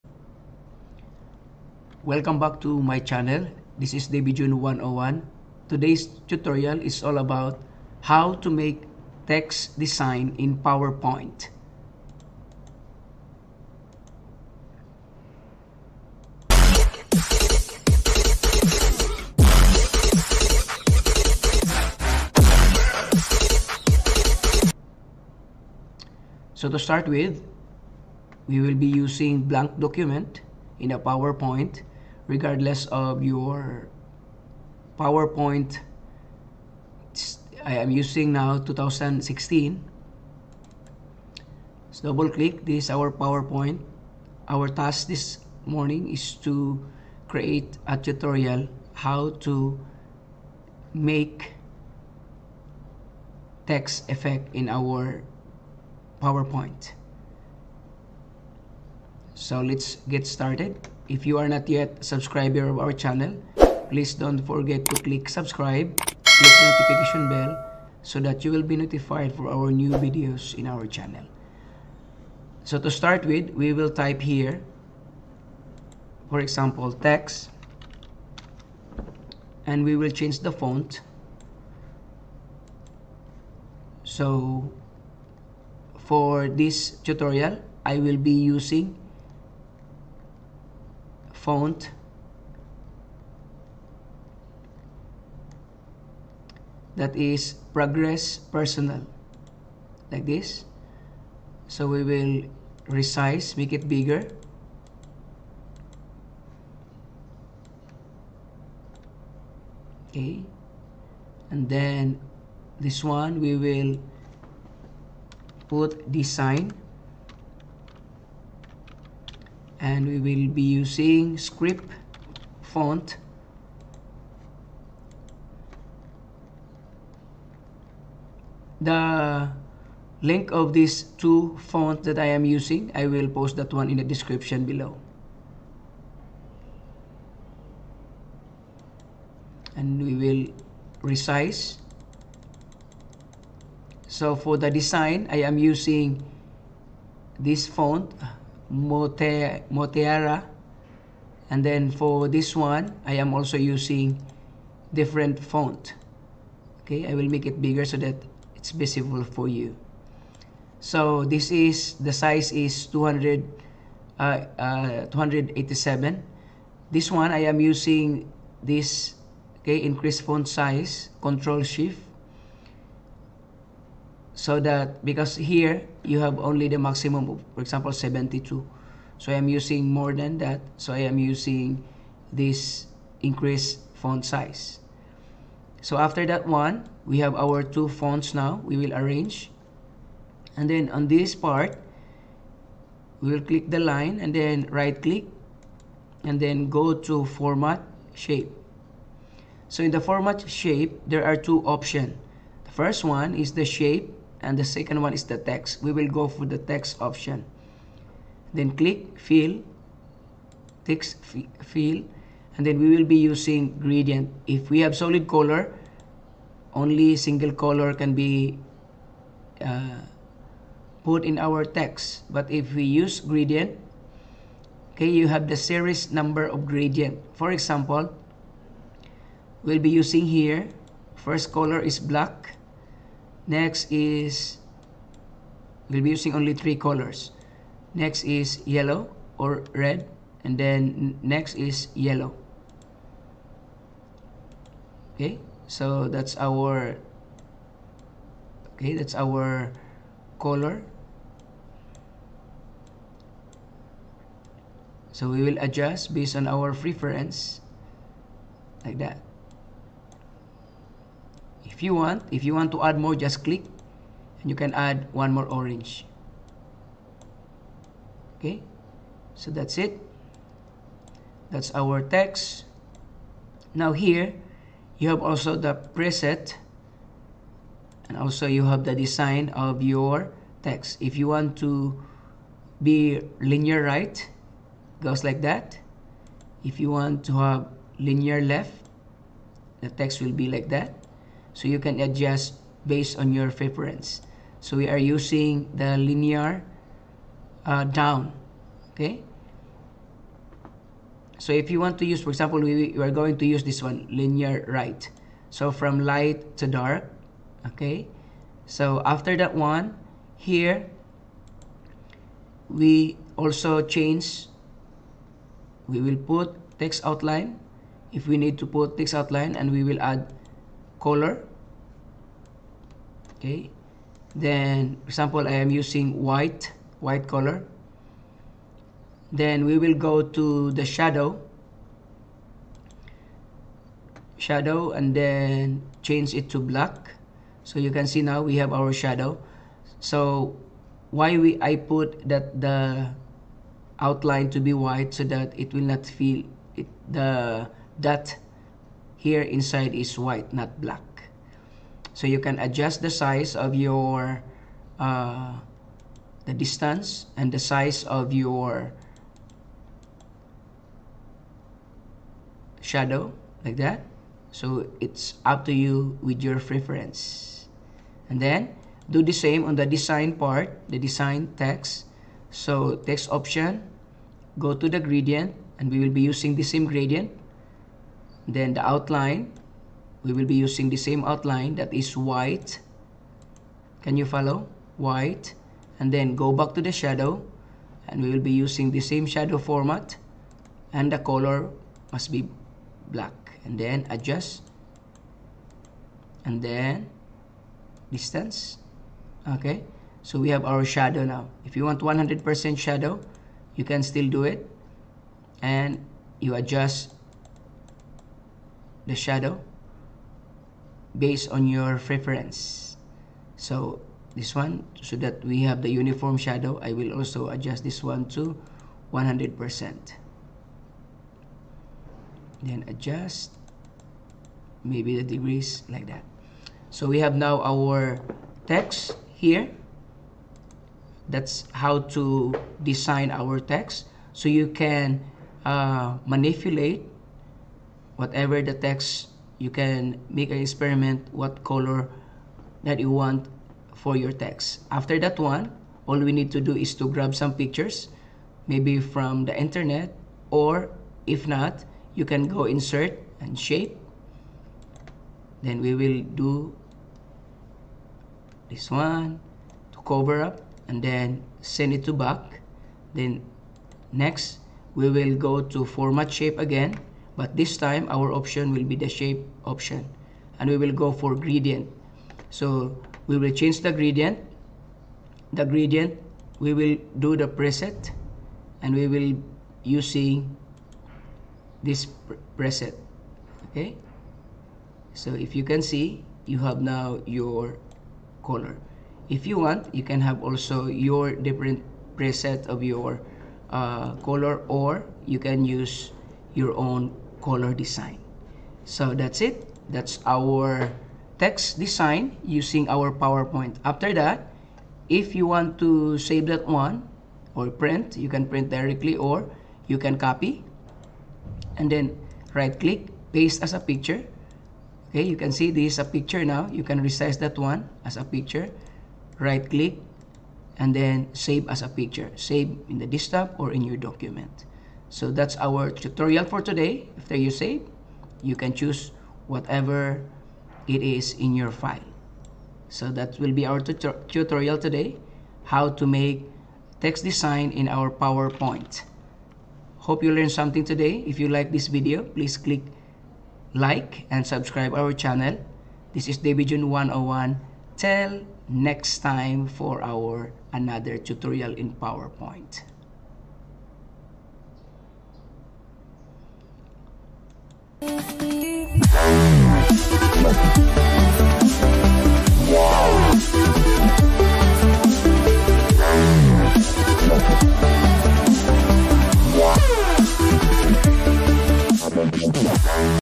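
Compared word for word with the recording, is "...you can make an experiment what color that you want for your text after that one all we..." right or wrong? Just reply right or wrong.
right.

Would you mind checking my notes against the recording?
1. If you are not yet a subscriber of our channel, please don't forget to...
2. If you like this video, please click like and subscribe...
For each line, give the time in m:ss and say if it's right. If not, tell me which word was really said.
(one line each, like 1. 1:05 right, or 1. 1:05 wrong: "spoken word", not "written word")
1. 1:01 right
2. 9:01 right.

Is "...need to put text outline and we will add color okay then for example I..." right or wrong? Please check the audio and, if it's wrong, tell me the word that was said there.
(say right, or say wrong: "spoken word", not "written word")
right.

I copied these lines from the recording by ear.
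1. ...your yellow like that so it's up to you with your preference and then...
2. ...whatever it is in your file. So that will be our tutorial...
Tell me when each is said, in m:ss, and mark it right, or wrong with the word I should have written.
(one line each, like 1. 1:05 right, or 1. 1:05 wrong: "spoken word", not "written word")
1. 5:58 wrong: "shadow", not "yellow"
2. 8:49 right.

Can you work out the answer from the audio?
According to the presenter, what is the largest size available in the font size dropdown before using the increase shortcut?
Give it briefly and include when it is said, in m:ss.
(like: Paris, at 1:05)
72, at 2:57.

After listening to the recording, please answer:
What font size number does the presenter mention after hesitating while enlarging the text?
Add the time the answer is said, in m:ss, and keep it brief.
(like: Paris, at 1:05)
287, at 2:45.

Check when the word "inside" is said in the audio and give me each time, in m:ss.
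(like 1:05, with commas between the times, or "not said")
5:49.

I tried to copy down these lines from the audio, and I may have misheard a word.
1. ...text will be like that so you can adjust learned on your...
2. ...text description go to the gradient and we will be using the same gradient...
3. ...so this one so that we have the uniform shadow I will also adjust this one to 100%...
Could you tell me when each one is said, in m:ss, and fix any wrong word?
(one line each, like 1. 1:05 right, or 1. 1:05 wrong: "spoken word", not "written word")
1. 4:49 wrong: "based", not "learned"
2. 6:13 wrong: "option", not "description"
3. 6:53 right.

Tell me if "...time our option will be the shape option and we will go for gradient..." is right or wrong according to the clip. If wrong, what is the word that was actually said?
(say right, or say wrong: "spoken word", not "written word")
right.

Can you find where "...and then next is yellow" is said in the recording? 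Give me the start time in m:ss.
4:00.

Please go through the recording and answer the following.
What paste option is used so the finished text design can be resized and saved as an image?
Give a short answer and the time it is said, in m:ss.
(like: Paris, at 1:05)
Paste as a picture, at 8:33.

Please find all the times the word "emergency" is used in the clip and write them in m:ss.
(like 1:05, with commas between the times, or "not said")
not said.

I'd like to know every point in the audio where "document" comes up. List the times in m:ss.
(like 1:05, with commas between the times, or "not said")
0:29, 8:43.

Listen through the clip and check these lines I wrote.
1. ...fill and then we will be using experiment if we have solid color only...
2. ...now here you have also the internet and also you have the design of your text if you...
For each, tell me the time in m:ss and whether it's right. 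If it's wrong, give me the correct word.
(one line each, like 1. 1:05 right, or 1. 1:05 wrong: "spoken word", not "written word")
1. 3:31 wrong: "gradient", not "experiment"
2. 4:33 wrong: "preset", not "internet".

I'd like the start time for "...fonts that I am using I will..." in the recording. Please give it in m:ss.
2:11.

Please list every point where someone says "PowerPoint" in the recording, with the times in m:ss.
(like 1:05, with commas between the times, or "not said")
0:10, 0:30, 0:34, 0:43, 0:56, 8:23, 8:58, 9:11.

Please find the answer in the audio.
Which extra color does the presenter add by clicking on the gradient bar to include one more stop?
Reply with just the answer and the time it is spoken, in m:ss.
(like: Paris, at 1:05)
Orange, at 4:25.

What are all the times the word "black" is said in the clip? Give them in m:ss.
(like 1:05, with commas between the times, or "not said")
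3:51, 5:36, 5:50, 6:33.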